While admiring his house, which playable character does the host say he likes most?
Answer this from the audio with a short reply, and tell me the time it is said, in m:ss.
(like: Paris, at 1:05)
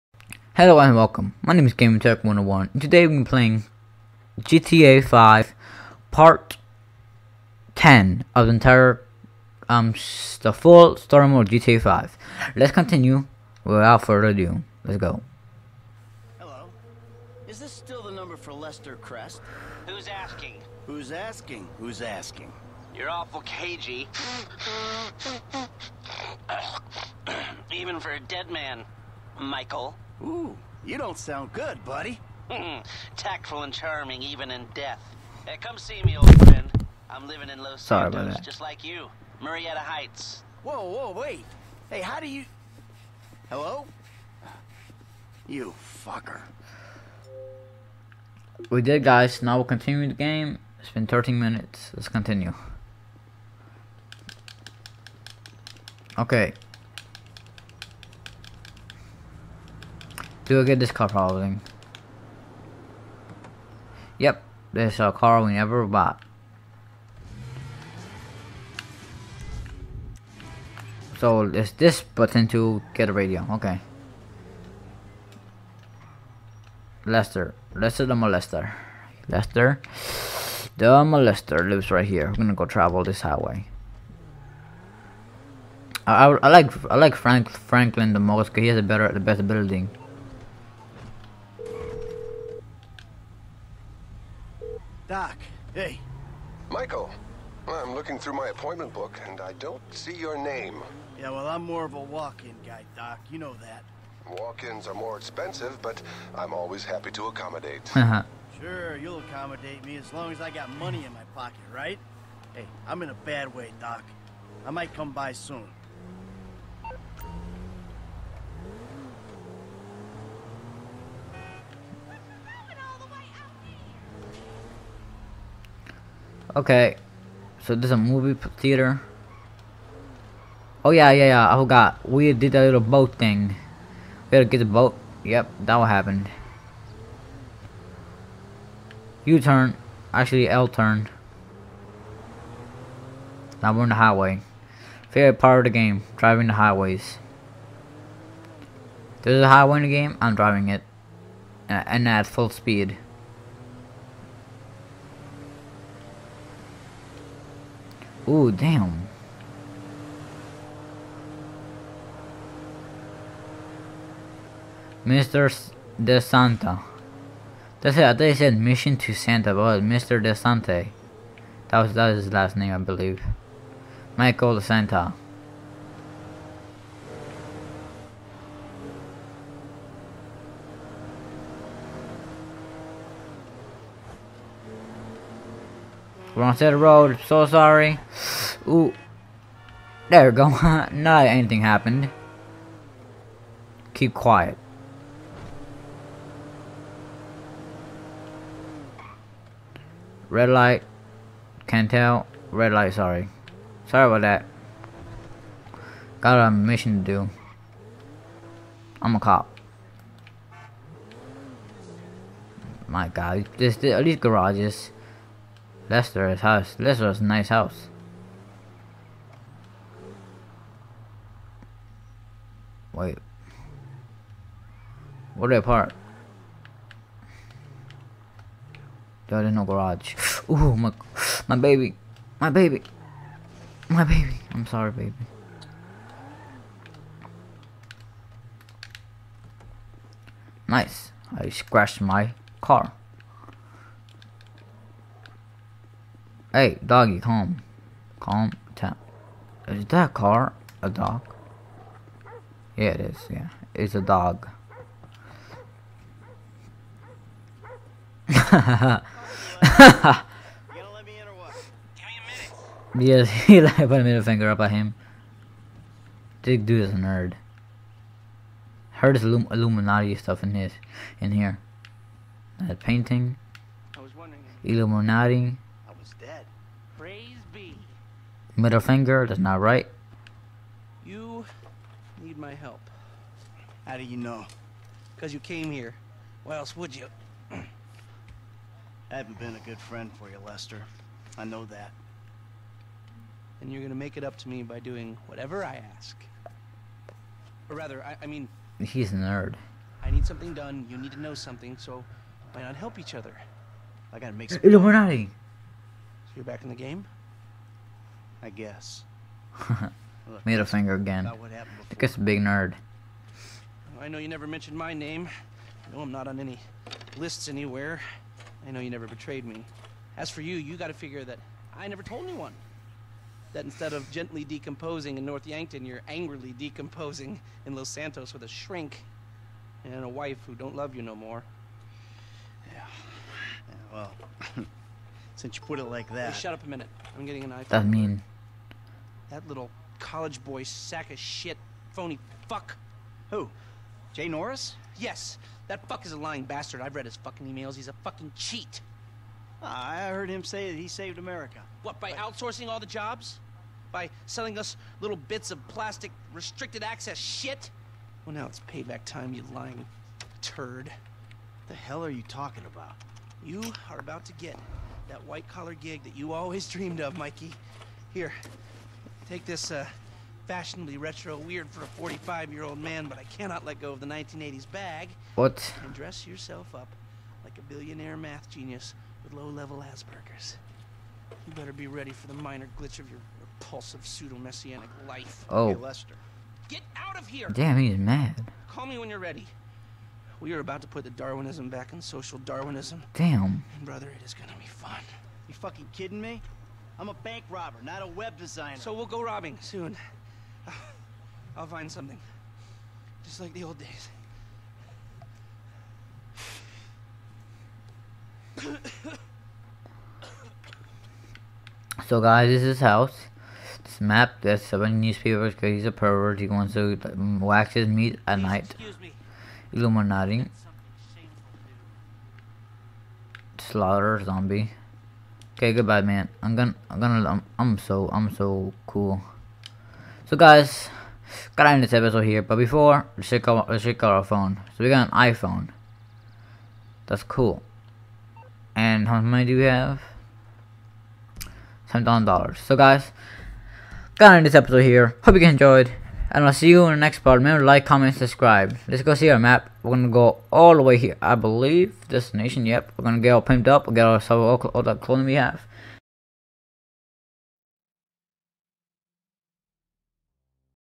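Franklin, at 1:27.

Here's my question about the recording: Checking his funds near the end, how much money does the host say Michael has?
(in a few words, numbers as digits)
7,000 dollars.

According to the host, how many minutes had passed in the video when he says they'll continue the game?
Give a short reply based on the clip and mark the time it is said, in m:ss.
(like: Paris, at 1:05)
13, at 0:51.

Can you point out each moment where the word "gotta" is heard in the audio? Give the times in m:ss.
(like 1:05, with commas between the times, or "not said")
5:04, 5:20, 7:11, 7:24.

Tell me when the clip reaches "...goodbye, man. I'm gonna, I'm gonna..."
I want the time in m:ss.
7:05.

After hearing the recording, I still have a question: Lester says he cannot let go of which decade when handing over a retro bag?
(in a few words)
1980s.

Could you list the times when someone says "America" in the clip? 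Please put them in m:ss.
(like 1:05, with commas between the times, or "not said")
5:51.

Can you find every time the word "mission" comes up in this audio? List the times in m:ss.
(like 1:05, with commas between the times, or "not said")
2:48, 3:26.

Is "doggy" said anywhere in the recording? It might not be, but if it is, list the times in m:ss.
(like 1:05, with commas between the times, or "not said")
4:06.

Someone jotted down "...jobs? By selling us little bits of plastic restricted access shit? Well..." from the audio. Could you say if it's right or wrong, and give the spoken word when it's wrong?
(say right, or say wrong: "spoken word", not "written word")
right.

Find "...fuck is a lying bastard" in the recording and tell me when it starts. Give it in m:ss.
5:45.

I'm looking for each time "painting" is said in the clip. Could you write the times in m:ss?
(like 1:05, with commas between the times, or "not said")
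4:32.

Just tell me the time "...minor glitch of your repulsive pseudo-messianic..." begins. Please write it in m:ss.
6:22.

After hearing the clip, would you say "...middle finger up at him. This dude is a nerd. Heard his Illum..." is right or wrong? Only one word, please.
right.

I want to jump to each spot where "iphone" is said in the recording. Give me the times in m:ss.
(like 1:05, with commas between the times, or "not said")
5:37, 7:15.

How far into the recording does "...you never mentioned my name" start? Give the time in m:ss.
5:14.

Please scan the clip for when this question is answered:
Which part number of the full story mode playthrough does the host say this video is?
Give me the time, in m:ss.
0:06.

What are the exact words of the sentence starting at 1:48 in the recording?
Sure, you'll accommodate me as long as I got money in my pocket, right?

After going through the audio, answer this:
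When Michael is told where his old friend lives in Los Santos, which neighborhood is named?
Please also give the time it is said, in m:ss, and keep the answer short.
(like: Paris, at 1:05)
Murrieta Heights, at 0:39.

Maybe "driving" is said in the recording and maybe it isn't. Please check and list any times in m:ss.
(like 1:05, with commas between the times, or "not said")
2:26, 2:30.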